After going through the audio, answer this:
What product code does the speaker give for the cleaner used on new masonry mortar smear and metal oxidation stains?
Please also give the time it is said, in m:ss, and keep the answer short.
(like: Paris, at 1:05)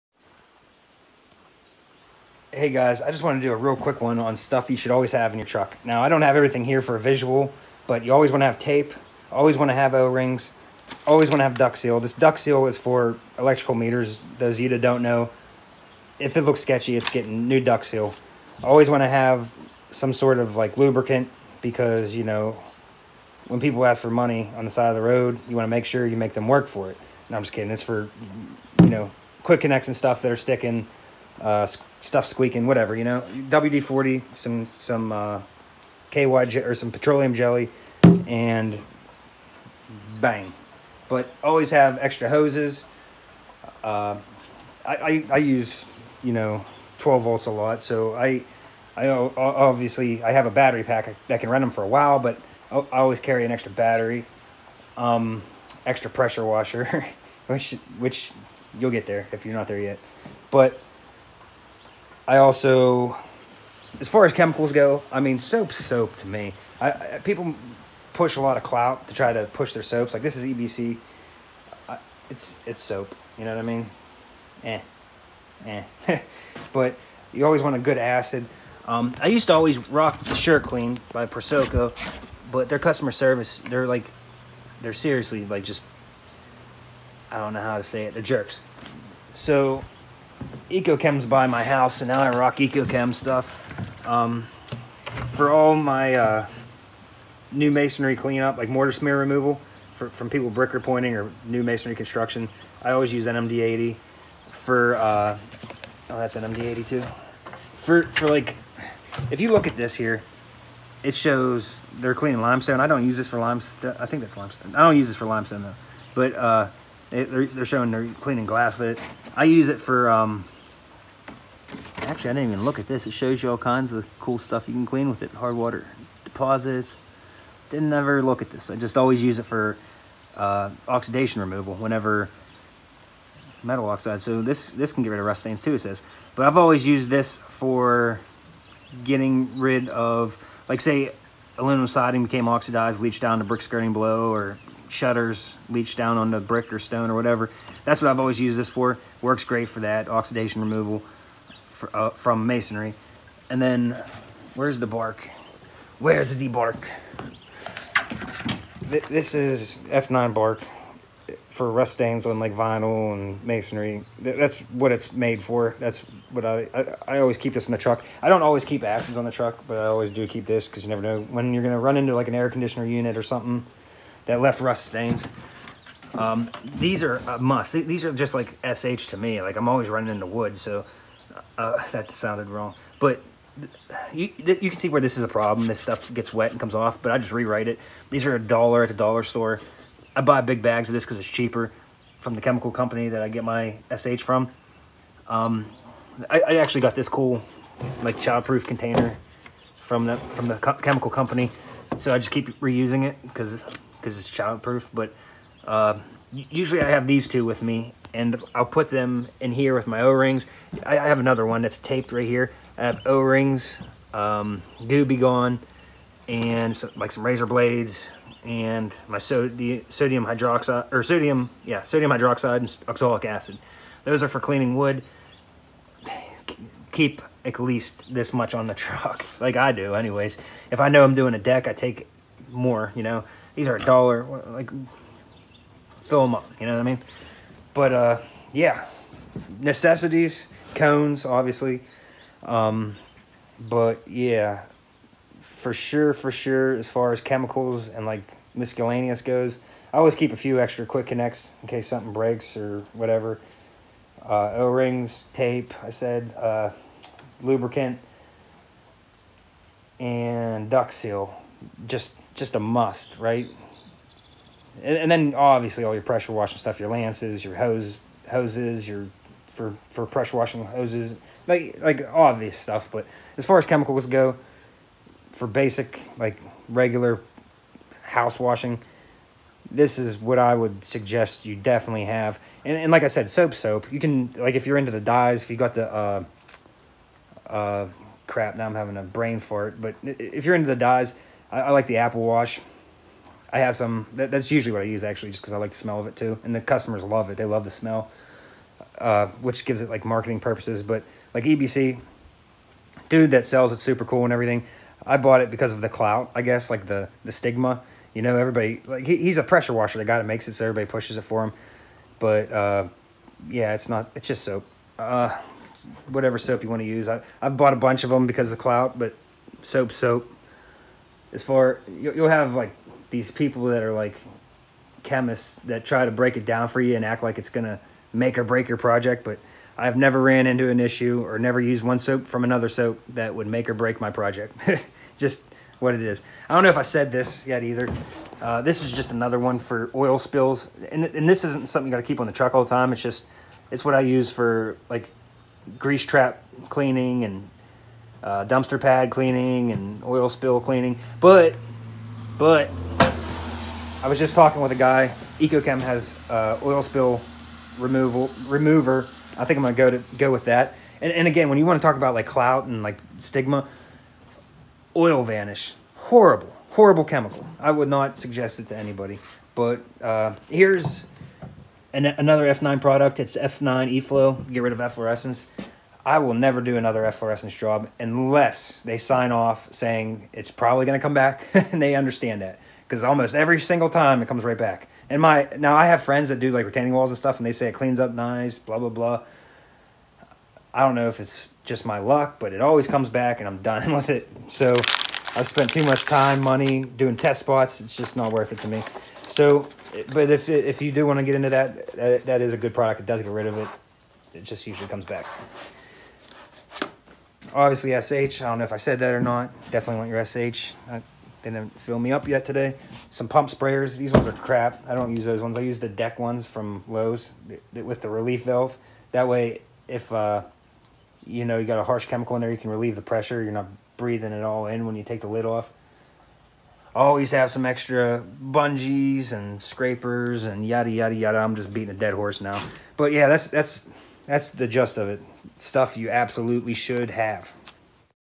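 NMD 82, at 1:46.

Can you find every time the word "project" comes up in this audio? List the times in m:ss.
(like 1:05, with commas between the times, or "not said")
5:28, 5:34.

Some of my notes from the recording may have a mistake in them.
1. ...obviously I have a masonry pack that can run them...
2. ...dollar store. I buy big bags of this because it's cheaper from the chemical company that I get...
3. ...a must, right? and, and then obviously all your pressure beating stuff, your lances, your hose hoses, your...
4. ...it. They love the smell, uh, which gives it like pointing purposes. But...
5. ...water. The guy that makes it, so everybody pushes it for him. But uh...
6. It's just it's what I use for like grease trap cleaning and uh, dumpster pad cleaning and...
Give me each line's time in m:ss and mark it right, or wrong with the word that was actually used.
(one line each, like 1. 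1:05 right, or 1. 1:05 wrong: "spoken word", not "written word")
1. 0:49 wrong: "battery", not "masonry"
2. 3:08 right
3. 4:22 wrong: "washing", not "beating"
4. 4:57 wrong: "marketing", not "pointing"
5. 5:09 wrong: "washer", not "water"
6. 5:42 right.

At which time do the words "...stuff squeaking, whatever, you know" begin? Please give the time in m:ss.
0:32.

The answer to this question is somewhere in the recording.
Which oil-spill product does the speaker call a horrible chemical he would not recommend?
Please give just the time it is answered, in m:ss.
6:04.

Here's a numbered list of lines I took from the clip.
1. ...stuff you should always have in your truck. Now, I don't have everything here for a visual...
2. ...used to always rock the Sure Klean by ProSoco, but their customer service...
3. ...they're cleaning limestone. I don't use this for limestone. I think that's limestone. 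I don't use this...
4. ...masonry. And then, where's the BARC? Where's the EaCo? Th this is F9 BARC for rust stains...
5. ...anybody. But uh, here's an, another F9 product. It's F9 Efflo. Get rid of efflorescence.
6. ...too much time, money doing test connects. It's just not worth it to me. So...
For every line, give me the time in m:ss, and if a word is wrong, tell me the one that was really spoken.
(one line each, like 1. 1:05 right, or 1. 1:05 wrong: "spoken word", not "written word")
1. 0:04 right
2. 1:19 right
3. 1:51 right
4. 2:32 wrong: "BARC", not "EaCo"
5. 6:08 right
6. 6:35 wrong: "spots", not "connects".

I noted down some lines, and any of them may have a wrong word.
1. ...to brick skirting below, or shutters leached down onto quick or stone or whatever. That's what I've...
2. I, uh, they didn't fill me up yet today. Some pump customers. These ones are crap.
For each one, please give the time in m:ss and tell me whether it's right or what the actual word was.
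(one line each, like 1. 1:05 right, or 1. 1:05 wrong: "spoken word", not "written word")
1. 2:23 wrong: "brick", not "quick"
2. 6:50 wrong: "sprayers", not "customers".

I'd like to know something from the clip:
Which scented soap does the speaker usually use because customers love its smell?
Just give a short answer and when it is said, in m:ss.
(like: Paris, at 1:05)
Apple Wash, at 4:51.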